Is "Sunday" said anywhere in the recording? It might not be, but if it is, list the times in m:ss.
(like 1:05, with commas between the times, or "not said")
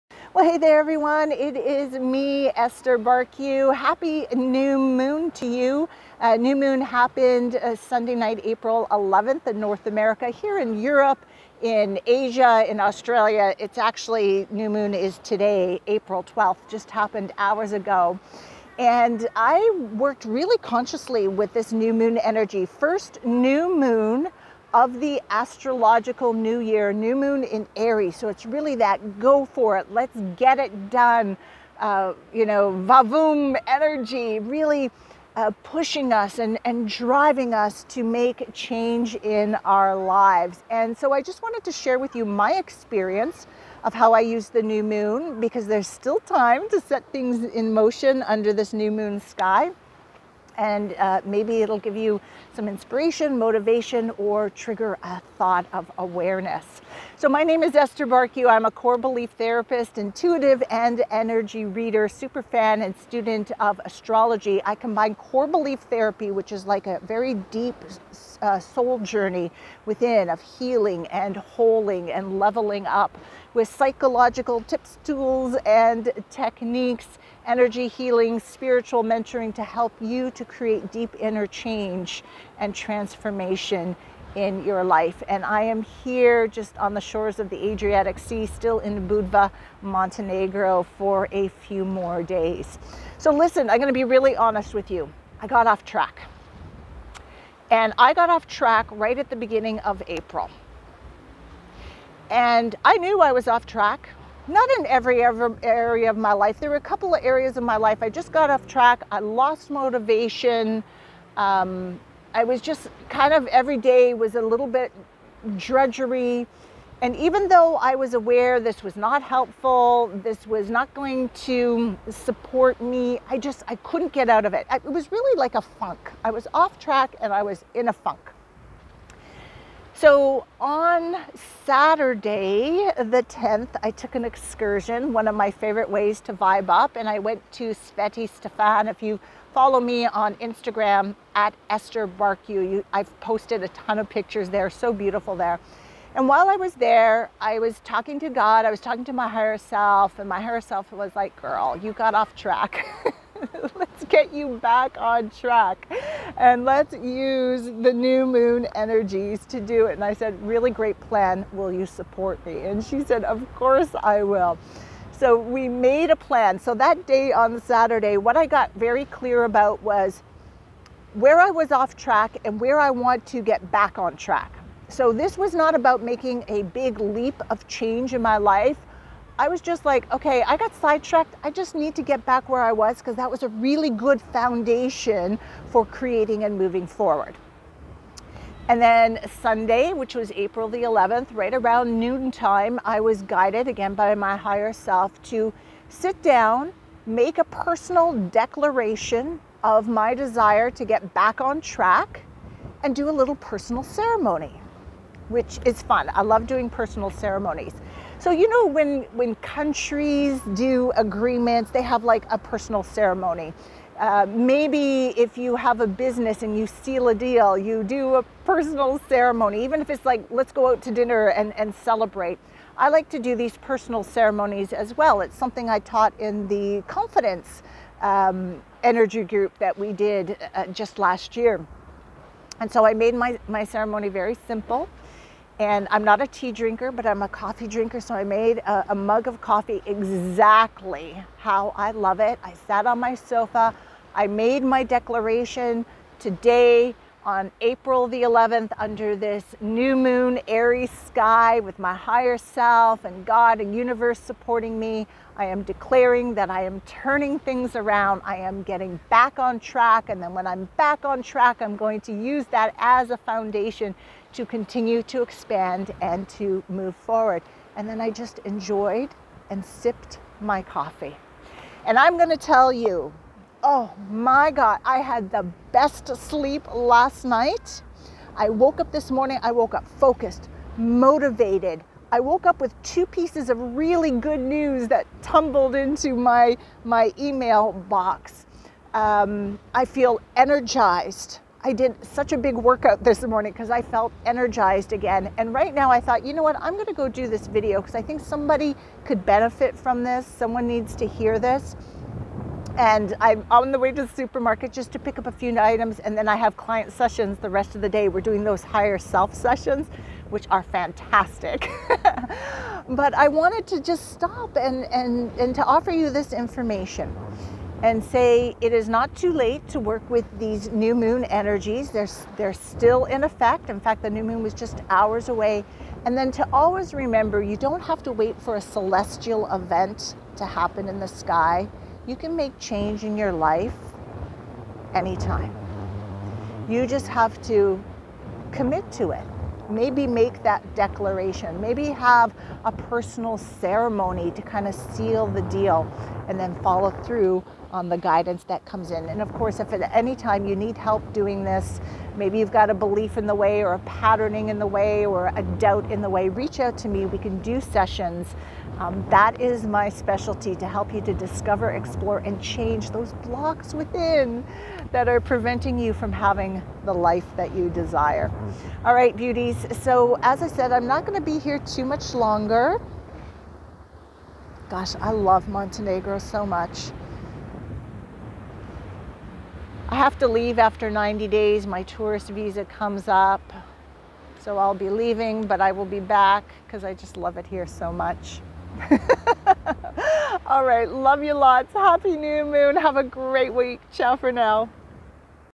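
0:07, 3:09.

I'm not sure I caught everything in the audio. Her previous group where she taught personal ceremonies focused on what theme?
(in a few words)
confidence.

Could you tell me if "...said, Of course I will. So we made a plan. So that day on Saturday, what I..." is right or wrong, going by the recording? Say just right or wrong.
right.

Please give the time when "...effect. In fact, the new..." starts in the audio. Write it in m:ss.
5:23.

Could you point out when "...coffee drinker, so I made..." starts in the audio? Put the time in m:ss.
3:57.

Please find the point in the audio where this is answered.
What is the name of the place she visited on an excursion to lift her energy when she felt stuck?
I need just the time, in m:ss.
2:17.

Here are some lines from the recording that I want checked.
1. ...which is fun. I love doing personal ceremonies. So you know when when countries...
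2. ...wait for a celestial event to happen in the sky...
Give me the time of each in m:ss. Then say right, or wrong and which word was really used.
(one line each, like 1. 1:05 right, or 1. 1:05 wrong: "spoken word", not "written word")
1. 3:25 right
2. 5:28 right.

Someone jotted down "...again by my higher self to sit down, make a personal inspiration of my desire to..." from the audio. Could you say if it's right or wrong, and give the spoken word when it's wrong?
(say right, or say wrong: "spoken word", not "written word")
wrong: "declaration", not "inspiration".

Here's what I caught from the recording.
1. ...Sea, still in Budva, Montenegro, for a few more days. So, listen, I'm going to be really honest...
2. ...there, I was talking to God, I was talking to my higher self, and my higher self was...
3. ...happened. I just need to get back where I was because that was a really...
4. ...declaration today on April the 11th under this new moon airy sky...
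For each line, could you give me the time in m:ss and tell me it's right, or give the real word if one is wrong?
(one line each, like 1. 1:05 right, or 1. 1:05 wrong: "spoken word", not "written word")
1. 1:28 right
2. 2:26 right
3. 3:00 wrong: "sidetracked", not "happened"
4. 4:04 right.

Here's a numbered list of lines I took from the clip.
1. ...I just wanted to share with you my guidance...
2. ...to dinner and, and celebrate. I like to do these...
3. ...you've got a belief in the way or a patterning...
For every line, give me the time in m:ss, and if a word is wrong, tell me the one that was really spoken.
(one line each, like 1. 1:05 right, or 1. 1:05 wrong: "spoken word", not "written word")
1. 0:41 wrong: "experience", not "guidance"
2. 3:40 right
3. 5:52 right.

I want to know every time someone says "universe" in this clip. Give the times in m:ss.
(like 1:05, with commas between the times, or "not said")
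4:13.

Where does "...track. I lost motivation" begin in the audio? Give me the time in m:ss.
1:48.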